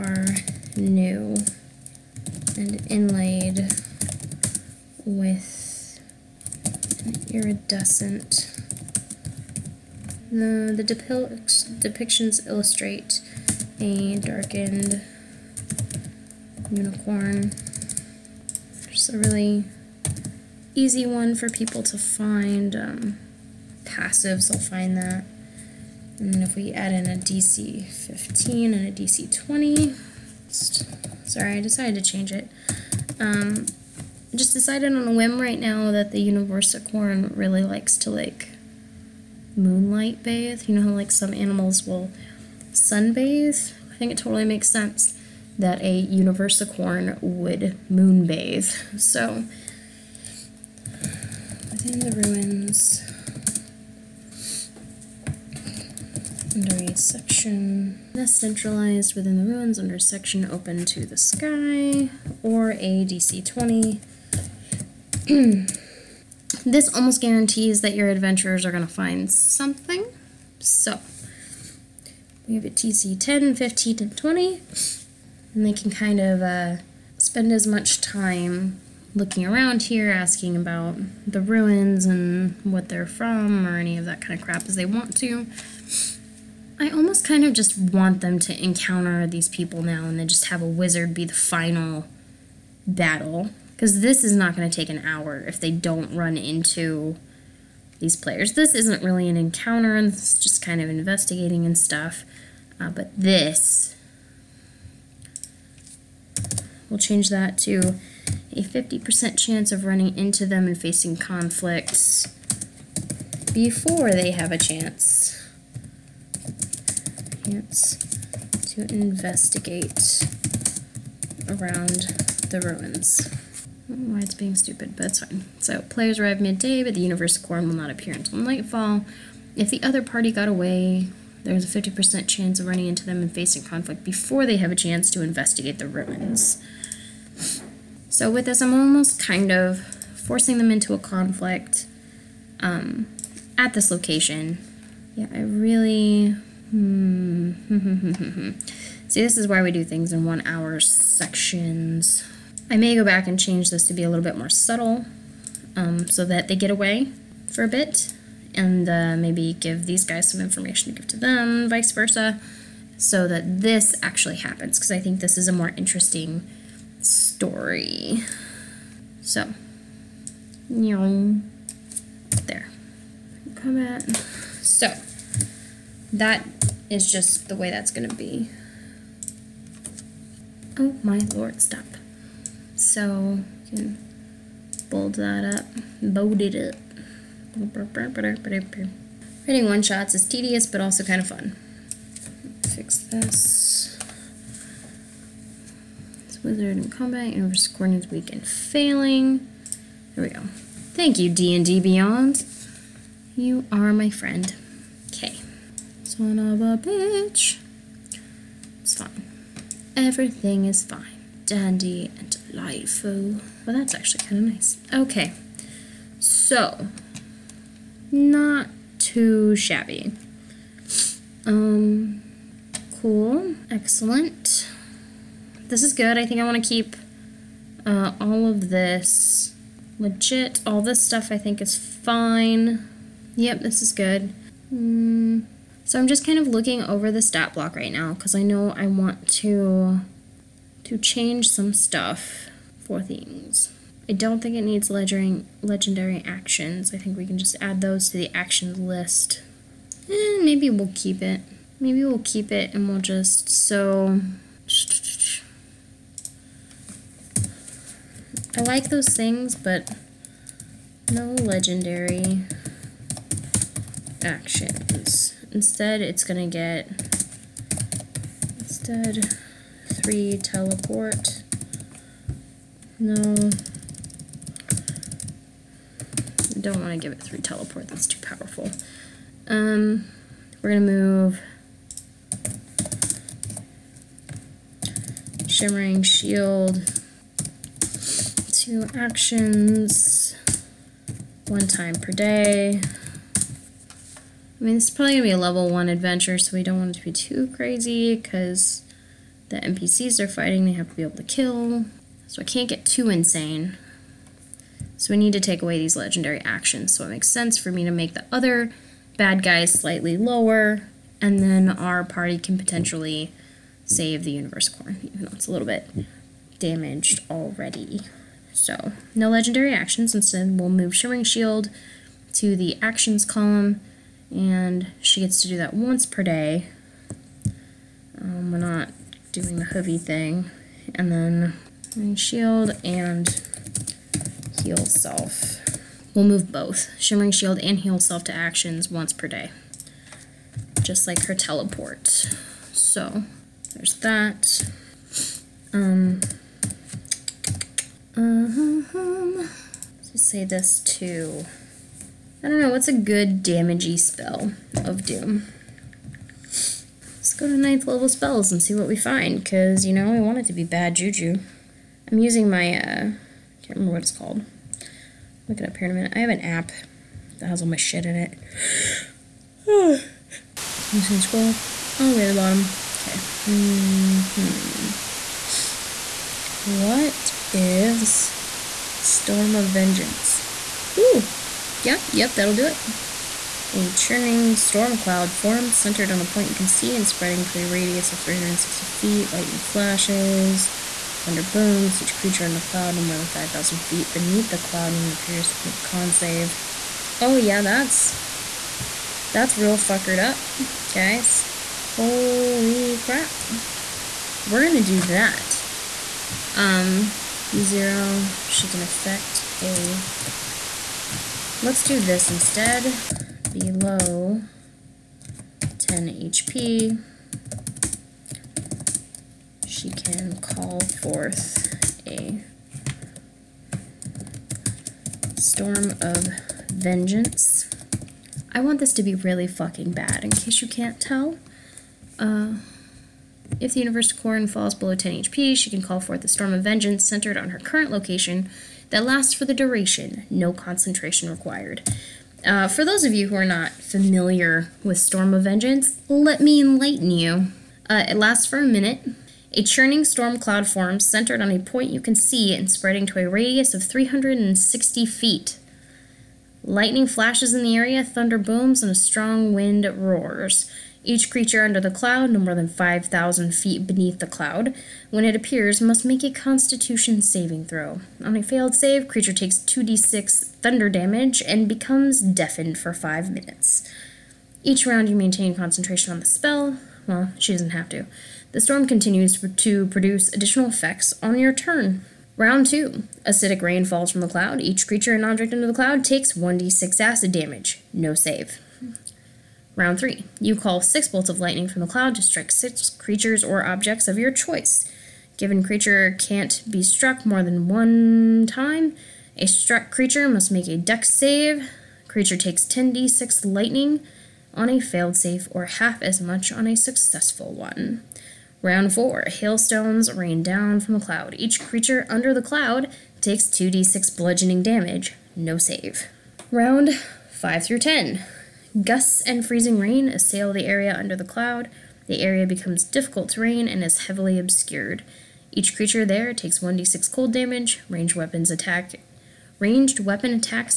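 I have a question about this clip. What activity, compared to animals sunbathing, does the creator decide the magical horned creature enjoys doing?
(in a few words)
Moonbathe.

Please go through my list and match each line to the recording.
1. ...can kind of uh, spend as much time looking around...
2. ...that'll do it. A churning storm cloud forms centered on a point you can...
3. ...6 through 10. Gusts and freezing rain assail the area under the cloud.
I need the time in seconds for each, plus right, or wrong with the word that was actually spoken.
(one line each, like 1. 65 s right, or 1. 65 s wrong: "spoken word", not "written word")
1. 75 s right
2. 382 s right
3. 517 s wrong: "5", not "6".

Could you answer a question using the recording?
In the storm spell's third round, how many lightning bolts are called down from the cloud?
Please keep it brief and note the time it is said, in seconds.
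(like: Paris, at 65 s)
6, at 490 s.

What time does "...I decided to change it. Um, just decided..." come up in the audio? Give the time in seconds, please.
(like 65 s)
31 s.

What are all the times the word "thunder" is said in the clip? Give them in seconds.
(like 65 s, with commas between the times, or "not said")
391 s, 458 s, 470 s.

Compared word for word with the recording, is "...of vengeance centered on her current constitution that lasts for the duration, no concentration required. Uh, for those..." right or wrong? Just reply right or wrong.
wrong.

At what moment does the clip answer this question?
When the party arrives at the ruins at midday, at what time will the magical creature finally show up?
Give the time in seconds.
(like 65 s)
128 s.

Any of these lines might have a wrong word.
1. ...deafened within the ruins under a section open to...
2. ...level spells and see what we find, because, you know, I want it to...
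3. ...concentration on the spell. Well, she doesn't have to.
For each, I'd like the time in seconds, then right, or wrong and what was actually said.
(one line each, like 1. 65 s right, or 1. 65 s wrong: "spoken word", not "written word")
1. 58 s wrong: "centralized", not "deafened"
2. 357 s right
3. 475 s right.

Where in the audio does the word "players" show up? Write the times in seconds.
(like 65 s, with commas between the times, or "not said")
98 s, 125 s.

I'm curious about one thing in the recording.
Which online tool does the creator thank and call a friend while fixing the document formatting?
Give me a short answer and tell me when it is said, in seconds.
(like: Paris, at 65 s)
D&D Beyond, at 201 s.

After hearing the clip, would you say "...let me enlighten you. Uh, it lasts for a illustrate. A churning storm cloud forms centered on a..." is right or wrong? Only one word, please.
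wrong.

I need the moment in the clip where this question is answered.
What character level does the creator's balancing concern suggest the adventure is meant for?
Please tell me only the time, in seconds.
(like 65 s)
295 s.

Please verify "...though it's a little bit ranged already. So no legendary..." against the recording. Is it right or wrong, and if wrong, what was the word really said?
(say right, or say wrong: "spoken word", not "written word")
wrong: "damaged", not "ranged".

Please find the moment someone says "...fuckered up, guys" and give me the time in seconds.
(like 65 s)
399 s.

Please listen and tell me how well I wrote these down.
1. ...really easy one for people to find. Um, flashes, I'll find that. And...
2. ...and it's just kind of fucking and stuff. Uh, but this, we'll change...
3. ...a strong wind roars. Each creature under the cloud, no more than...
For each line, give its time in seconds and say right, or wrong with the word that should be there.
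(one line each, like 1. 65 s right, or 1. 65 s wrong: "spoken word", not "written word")
1. 19 s wrong: "passives", not "flashes"
2. 99 s wrong: "investigating", not "fucking"
3. 458 s right.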